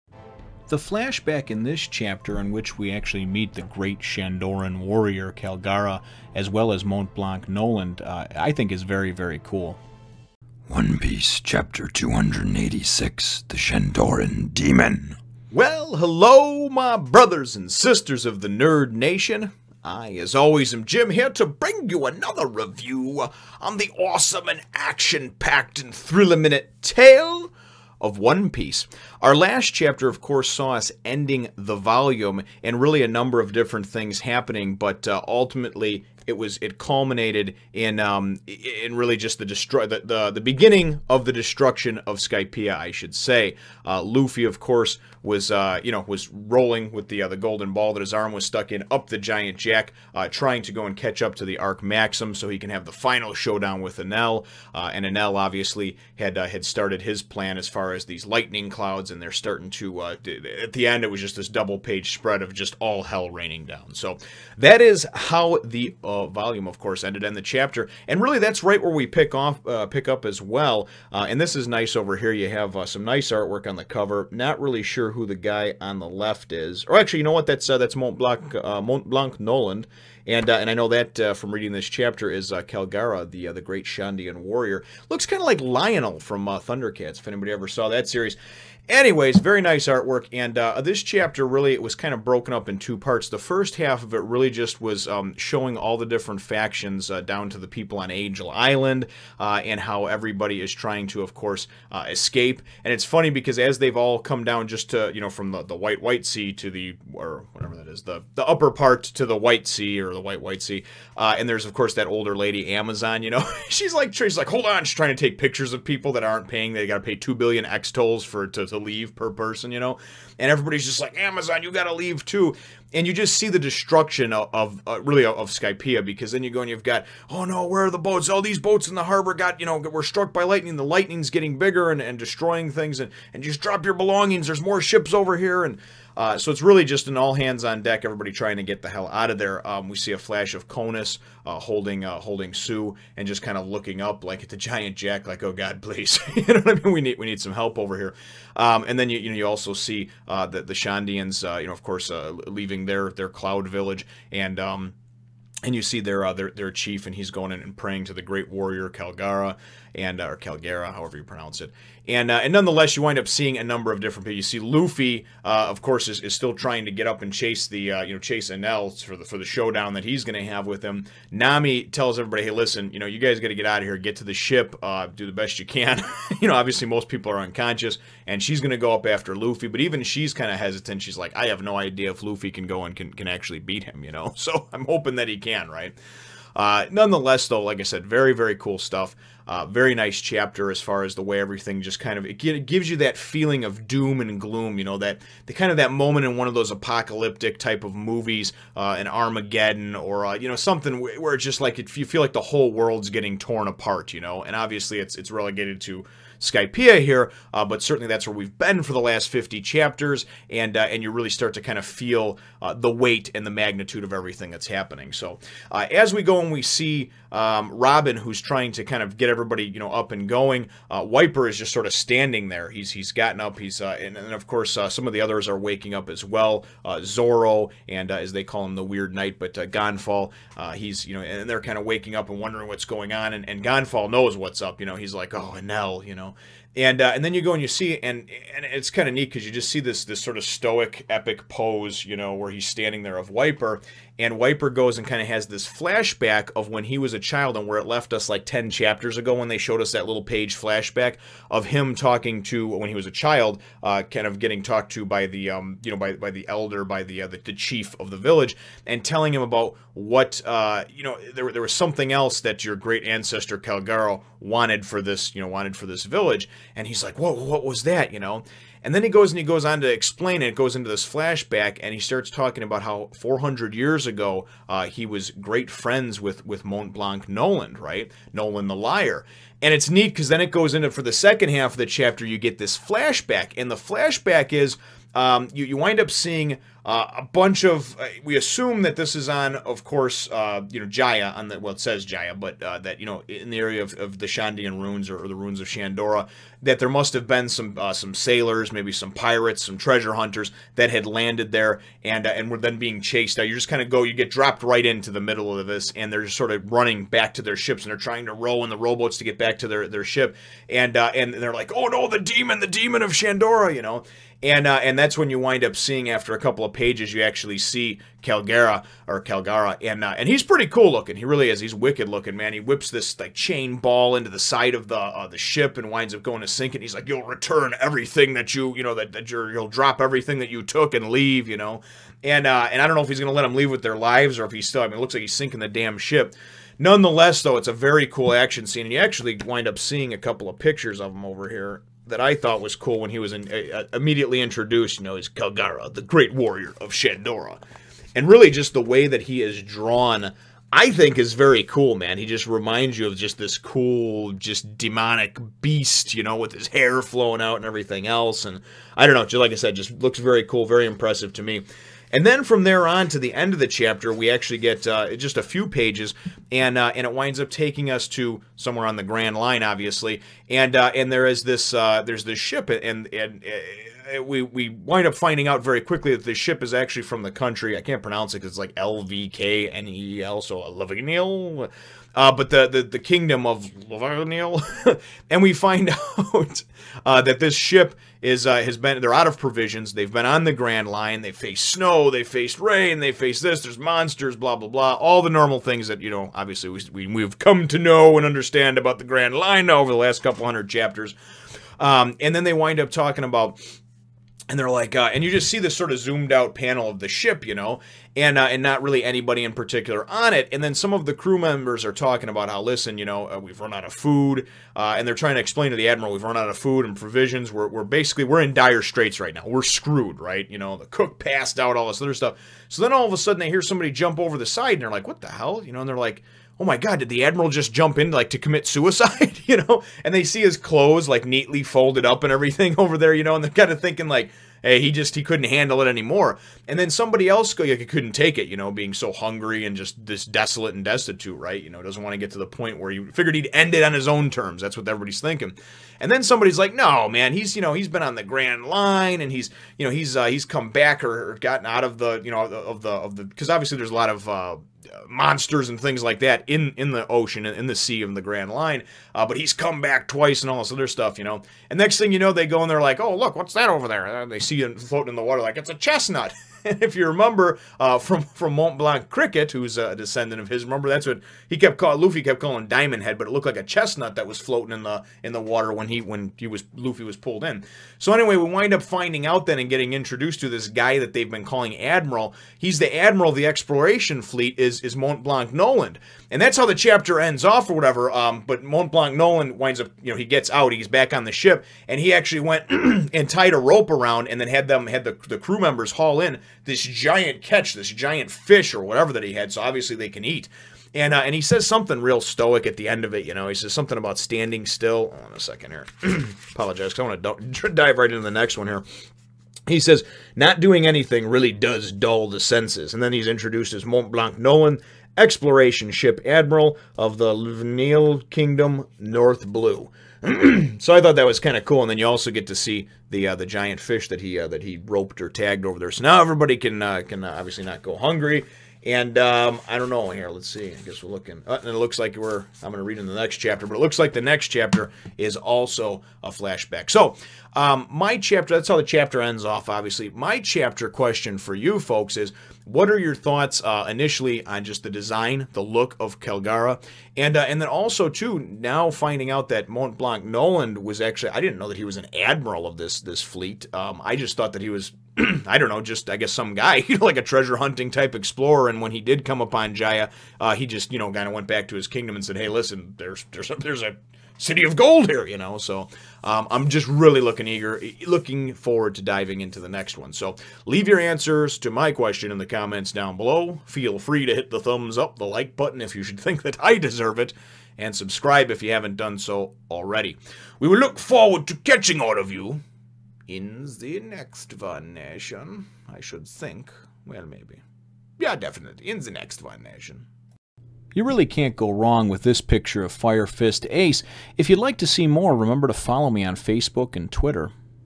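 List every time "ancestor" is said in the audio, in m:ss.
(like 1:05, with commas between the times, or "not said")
4:23.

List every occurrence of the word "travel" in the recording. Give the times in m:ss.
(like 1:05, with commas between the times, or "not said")
not said.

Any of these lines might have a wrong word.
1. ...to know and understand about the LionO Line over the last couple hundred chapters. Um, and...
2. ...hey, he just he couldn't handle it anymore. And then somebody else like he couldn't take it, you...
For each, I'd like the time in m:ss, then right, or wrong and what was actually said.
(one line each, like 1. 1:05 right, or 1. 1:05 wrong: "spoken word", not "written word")
1. 6:37 wrong: "Grand", not "LionO"
2. 7:14 right.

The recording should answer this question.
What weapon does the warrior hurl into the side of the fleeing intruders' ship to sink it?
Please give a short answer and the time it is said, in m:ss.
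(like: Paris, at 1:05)
chain ball, at 5:23.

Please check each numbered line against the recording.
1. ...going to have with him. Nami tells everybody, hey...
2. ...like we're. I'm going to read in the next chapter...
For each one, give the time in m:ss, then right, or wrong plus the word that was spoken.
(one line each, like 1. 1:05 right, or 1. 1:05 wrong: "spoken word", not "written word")
1. 2:50 right
2. 8:51 right.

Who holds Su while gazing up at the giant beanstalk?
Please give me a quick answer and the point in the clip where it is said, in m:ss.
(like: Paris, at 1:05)
Conis, at 2:20.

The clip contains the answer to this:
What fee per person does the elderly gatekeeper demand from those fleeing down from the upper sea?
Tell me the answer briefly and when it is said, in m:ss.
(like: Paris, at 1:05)
2 billion Extols, at 1:57.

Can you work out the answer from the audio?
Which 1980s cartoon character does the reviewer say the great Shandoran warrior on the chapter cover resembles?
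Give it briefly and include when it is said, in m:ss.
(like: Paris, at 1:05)
Lion-O, at 1:25.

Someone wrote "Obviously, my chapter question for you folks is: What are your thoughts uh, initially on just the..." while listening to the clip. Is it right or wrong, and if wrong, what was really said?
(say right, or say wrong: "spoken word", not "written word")
right.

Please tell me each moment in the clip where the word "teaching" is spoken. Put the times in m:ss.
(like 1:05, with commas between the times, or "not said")
not said.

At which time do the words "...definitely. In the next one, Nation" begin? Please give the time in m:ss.
9:48.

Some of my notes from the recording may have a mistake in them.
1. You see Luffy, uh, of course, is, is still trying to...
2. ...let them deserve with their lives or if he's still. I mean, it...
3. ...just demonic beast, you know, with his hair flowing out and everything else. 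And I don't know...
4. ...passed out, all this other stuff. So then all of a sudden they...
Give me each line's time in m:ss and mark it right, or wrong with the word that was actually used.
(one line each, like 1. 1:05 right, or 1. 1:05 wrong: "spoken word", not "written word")
1. 2:44 right
2. 5:33 wrong: "leave", not "deserve"
3. 5:54 right
4. 7:01 right.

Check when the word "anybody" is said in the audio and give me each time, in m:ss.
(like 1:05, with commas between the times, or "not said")
1:27, 6:49.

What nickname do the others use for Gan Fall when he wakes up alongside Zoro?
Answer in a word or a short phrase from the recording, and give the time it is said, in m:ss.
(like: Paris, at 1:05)
The Weird Knight, at 3:48.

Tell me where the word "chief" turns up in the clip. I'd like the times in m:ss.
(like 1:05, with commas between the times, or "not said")
2:36, 4:17.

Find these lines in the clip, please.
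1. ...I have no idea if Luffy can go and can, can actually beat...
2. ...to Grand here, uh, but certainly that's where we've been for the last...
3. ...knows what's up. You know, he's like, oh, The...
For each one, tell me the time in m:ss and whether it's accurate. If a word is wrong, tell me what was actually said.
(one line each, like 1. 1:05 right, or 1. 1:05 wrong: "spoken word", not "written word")
1. 3:01 right
2. 3:25 wrong: "Skypiea", not "Grand"
3. 3:54 wrong: "Enel", not "The".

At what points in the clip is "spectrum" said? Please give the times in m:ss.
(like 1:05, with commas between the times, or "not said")
not said.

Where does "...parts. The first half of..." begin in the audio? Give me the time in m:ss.
1:32.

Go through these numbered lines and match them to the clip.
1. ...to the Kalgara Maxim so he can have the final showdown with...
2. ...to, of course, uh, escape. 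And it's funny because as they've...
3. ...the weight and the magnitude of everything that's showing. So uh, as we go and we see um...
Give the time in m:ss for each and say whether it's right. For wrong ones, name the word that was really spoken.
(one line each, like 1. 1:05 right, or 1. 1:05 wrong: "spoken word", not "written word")
1. 0:51 wrong: "Arc", not "Kalgara"
2. 1:41 right
3. 3:32 wrong: "happening", not "showing".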